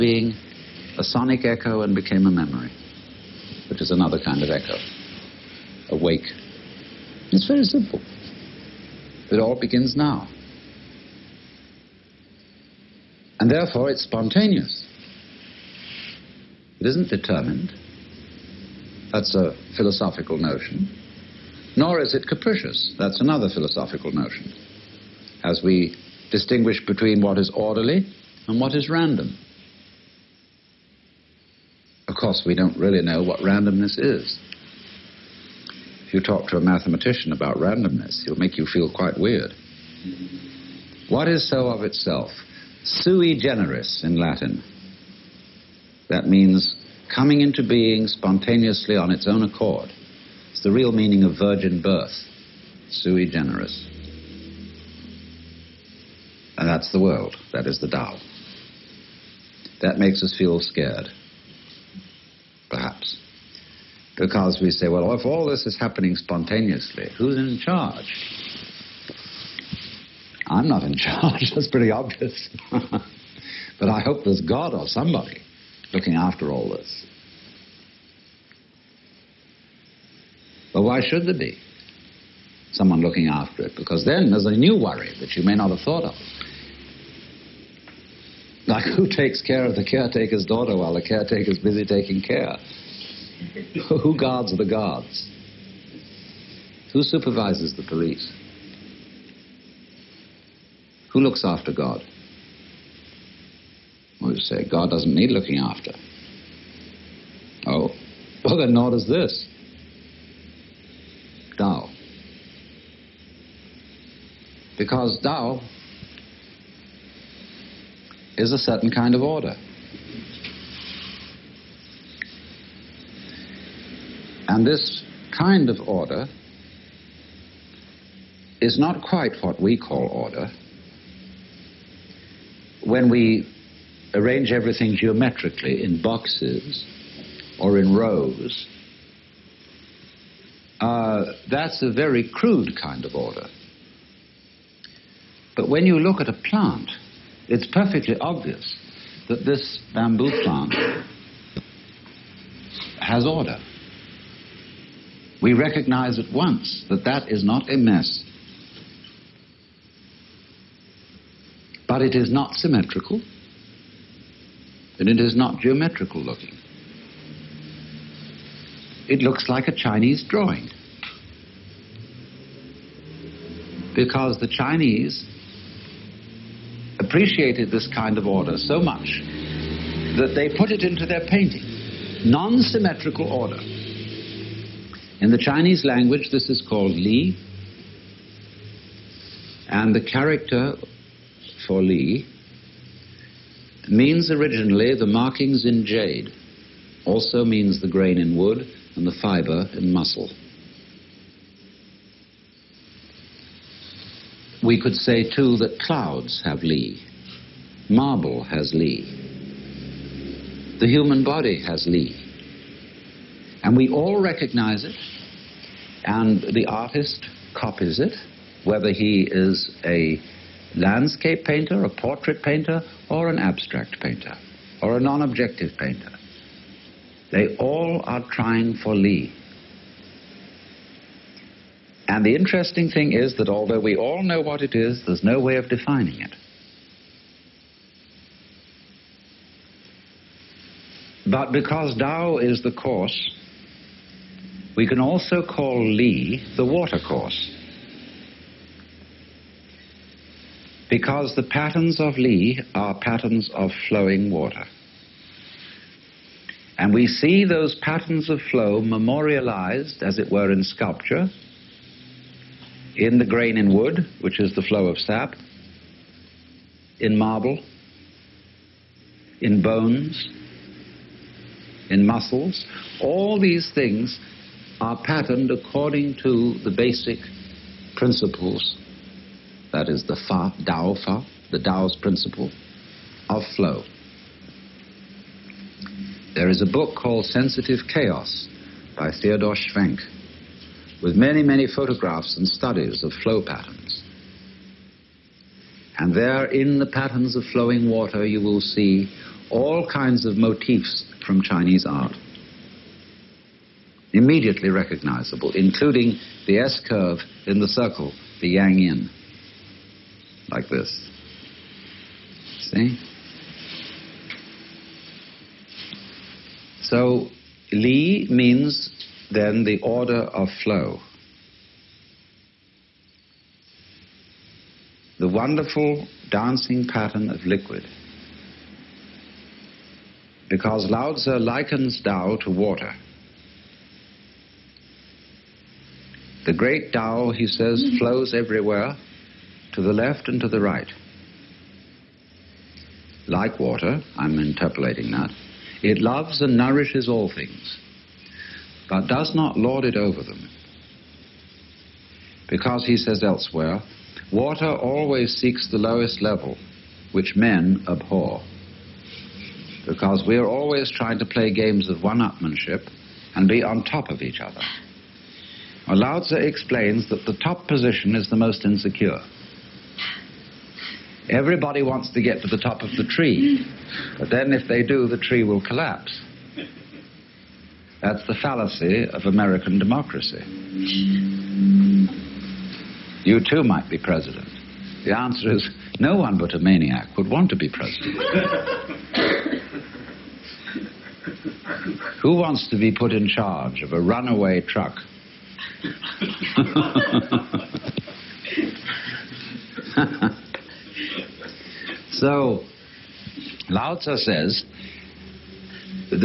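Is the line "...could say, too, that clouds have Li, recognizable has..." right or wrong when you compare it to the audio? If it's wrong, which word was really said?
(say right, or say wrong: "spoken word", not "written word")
wrong: "marble", not "recognizable".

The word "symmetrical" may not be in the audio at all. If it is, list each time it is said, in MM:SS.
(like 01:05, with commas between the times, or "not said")
02:42, 03:02.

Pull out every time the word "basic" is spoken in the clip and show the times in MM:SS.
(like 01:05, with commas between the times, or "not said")
04:36.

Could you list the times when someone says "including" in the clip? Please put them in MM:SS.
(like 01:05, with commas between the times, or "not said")
05:05.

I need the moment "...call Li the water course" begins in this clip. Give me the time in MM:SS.
04:05.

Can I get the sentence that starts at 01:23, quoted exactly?
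Because then there's a new worry that you may not have thought of.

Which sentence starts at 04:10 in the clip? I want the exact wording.
Because the patterns of Li are patterns of flowing water.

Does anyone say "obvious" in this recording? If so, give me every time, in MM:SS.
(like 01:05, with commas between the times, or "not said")
01:11, 02:28.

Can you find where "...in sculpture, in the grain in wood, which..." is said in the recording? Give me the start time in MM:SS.
04:20.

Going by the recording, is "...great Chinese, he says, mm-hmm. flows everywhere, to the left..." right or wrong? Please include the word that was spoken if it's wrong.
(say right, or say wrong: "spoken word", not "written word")
wrong: "Tao", not "Chinese".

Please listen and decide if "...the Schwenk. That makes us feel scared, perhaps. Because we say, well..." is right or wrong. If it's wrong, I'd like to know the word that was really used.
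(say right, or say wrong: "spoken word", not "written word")
wrong: "Tao", not "Schwenk".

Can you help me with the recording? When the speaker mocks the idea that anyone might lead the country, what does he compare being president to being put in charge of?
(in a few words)
a runaway truck.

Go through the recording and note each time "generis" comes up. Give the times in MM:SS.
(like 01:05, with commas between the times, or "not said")
00:43, 00:53.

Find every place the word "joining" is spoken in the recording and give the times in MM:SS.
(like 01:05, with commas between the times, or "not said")
not said.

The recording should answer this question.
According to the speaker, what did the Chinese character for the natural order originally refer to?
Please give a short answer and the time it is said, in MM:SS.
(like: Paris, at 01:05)
markings in jade, at 03:15.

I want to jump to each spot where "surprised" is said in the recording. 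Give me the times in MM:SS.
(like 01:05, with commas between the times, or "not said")
not said.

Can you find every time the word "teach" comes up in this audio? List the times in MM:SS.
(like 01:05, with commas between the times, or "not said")
not said.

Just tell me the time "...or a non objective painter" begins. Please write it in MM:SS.
03:44.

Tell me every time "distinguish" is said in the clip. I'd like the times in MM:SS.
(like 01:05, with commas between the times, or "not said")
00:26.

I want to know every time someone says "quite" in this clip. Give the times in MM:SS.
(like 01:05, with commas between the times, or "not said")
00:38, 02:09.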